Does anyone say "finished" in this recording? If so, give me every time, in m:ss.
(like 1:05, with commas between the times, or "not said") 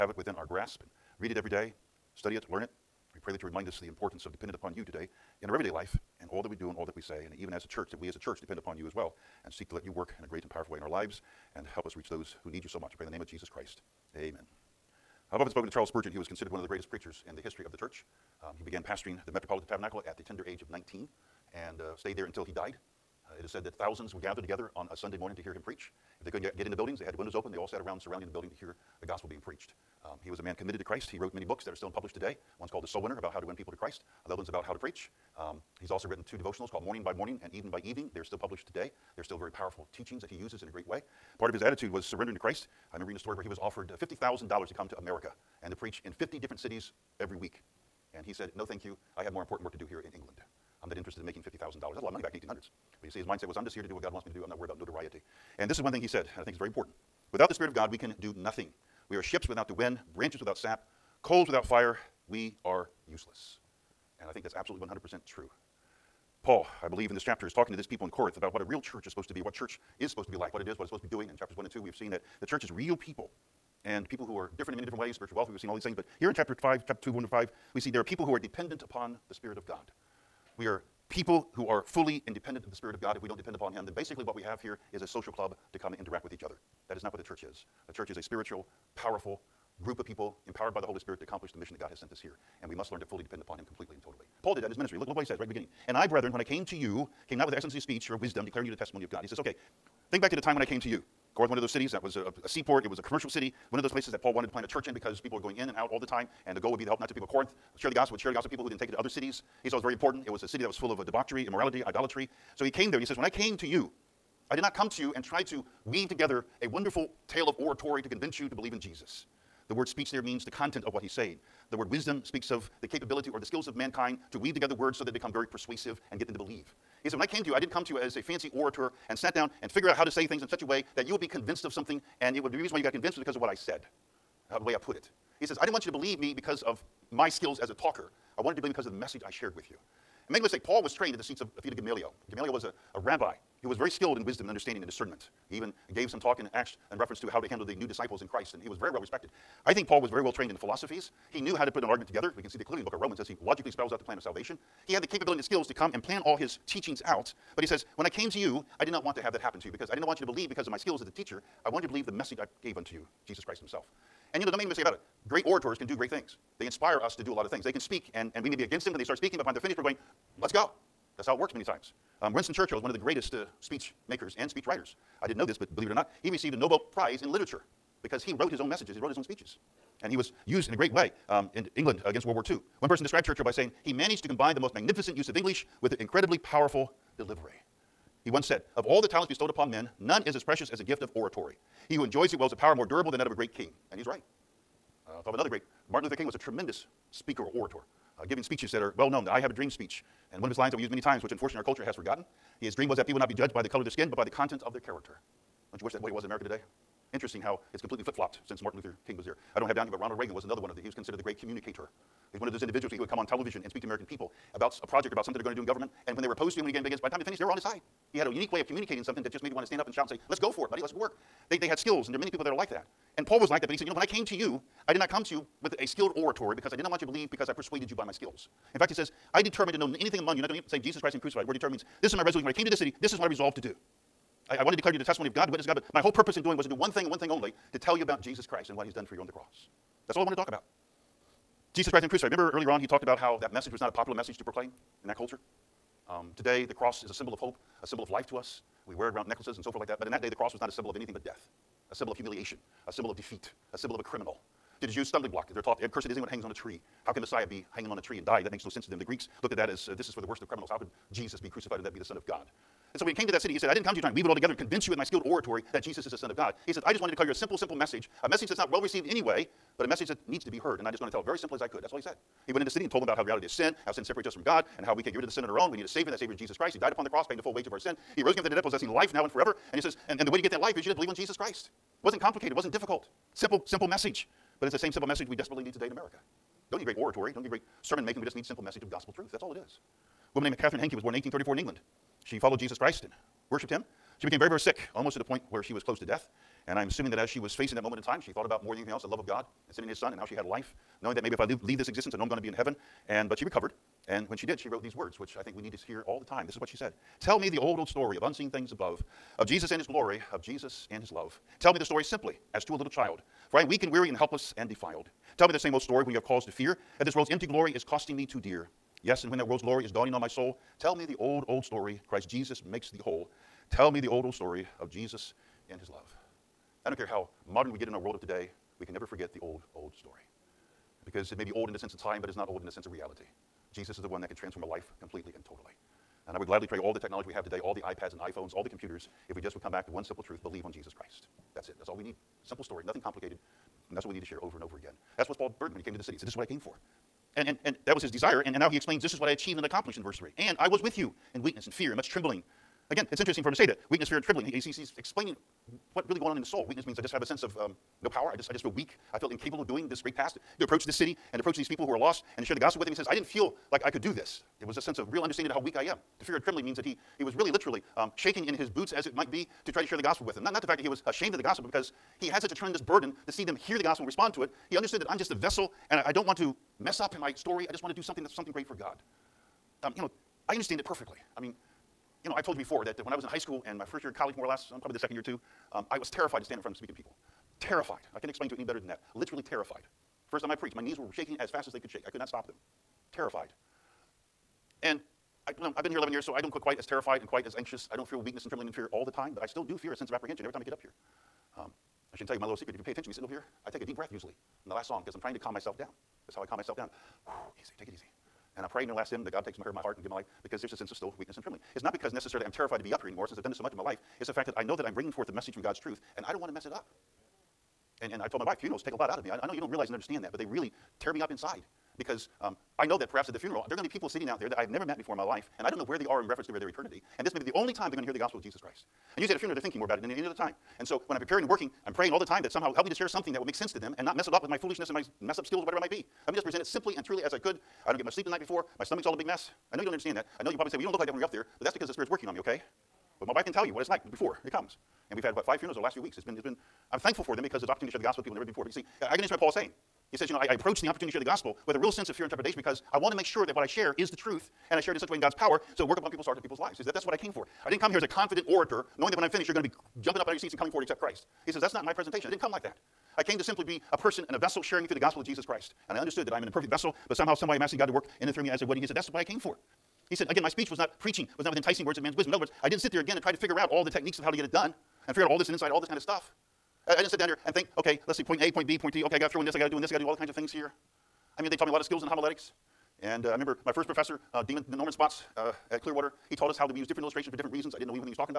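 2:49, 3:37, 7:39.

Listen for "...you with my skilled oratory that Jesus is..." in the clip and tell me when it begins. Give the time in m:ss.
4:24.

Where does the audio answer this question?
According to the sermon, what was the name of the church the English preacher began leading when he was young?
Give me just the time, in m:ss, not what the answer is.
0:19.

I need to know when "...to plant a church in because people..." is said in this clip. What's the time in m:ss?
1:44.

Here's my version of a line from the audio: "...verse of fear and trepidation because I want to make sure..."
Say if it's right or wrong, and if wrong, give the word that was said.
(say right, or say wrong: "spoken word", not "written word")
wrong: "sense", not "verse".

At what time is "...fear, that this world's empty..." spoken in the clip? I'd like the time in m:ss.
5:16.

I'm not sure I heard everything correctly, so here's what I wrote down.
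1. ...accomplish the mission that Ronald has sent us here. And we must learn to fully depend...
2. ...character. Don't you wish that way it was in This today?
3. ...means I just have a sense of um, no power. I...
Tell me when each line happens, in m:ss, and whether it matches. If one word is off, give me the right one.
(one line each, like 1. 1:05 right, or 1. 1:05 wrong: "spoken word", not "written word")
1. 1:31 wrong: "God", not "Ronald"
2. 3:24 wrong: "America", not "This"
3. 5:56 right.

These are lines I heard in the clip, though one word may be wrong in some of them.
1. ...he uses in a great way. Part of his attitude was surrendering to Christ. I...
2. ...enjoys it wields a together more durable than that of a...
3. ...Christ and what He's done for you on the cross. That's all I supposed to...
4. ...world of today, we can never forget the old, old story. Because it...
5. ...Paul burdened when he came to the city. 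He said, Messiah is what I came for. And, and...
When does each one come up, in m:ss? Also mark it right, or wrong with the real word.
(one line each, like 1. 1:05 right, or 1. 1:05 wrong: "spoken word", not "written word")
1. 0:40 right
2. 3:12 wrong: "power", not "together"
3. 3:58 wrong: "wanted", not "supposed"
4. 5:27 right
5. 5:45 wrong: "This", not "Messiah".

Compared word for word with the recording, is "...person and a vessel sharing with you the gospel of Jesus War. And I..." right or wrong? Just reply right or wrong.
wrong.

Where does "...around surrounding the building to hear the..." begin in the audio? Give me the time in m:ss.
0:27.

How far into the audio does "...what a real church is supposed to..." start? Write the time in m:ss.
1:08.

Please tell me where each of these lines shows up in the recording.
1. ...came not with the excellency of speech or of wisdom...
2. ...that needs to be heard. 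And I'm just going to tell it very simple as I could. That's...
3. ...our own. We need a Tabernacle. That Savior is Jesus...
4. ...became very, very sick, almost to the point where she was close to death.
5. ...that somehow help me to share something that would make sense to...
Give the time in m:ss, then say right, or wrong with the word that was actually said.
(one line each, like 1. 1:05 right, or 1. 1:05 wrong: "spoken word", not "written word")
1. 1:37 right
2. 4:30 right
3. 4:35 wrong: "Savior", not "Tabernacle"
4. 4:54 right
5. 7:12 right.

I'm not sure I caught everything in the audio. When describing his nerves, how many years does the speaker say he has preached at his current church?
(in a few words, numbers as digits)
11.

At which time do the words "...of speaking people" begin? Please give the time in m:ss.
6:26.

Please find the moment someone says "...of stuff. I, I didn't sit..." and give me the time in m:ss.
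7:55.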